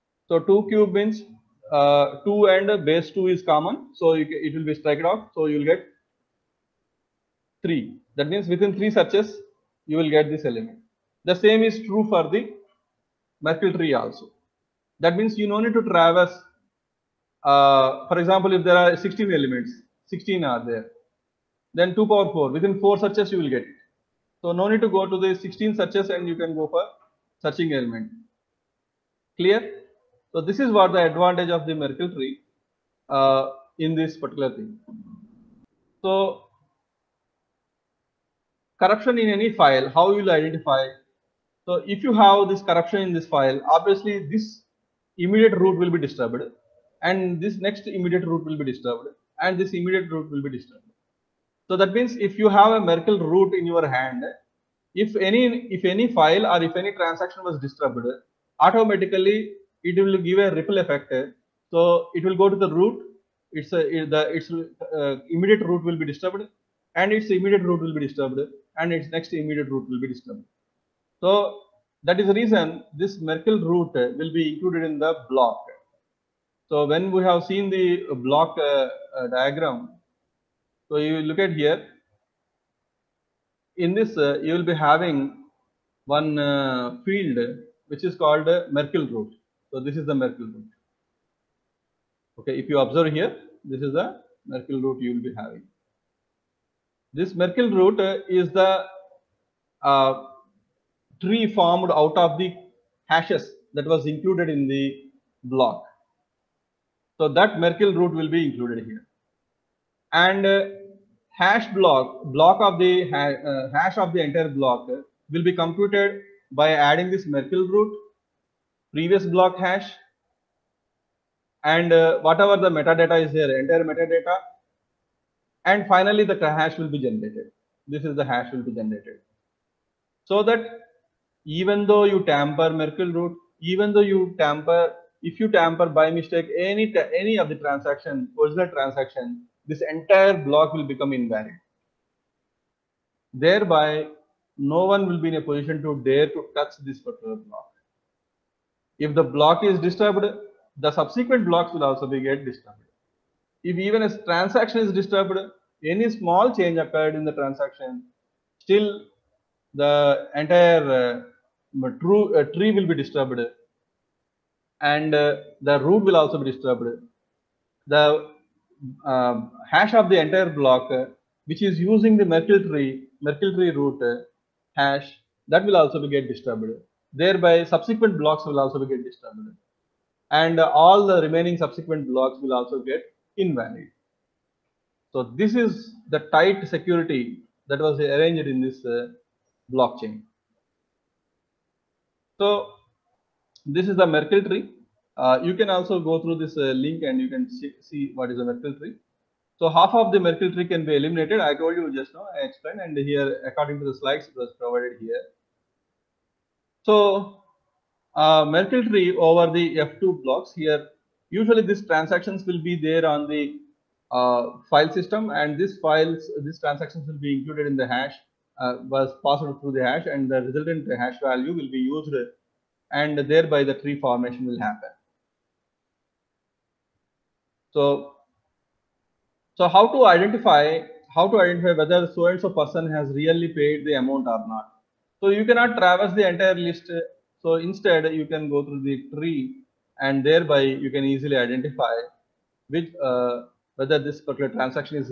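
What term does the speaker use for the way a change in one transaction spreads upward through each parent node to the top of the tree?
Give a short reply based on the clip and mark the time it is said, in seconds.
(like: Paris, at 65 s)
ripple effect, at 60 s.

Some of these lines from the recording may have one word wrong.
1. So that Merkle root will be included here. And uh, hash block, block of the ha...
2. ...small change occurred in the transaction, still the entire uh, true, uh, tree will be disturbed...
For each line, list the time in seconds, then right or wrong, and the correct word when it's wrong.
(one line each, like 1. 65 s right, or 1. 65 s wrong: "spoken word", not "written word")
1. 107 s right
2. 156 s right.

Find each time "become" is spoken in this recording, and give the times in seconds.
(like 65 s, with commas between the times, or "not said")
140 s.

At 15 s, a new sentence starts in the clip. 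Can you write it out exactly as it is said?
That means you no need to traverse.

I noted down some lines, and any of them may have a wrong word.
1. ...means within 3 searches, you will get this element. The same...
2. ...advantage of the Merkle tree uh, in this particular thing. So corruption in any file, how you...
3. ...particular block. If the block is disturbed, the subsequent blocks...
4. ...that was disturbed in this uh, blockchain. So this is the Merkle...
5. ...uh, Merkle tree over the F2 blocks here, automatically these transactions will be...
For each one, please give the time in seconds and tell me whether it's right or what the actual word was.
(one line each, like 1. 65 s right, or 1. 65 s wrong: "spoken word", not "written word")
1. 8 s right
2. 31 s right
3. 146 s right
4. 187 s wrong: "arranged", not "disturbed"
5. 208 s wrong: "usually", not "automatically".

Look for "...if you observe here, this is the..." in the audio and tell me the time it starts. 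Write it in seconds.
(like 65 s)
92 s.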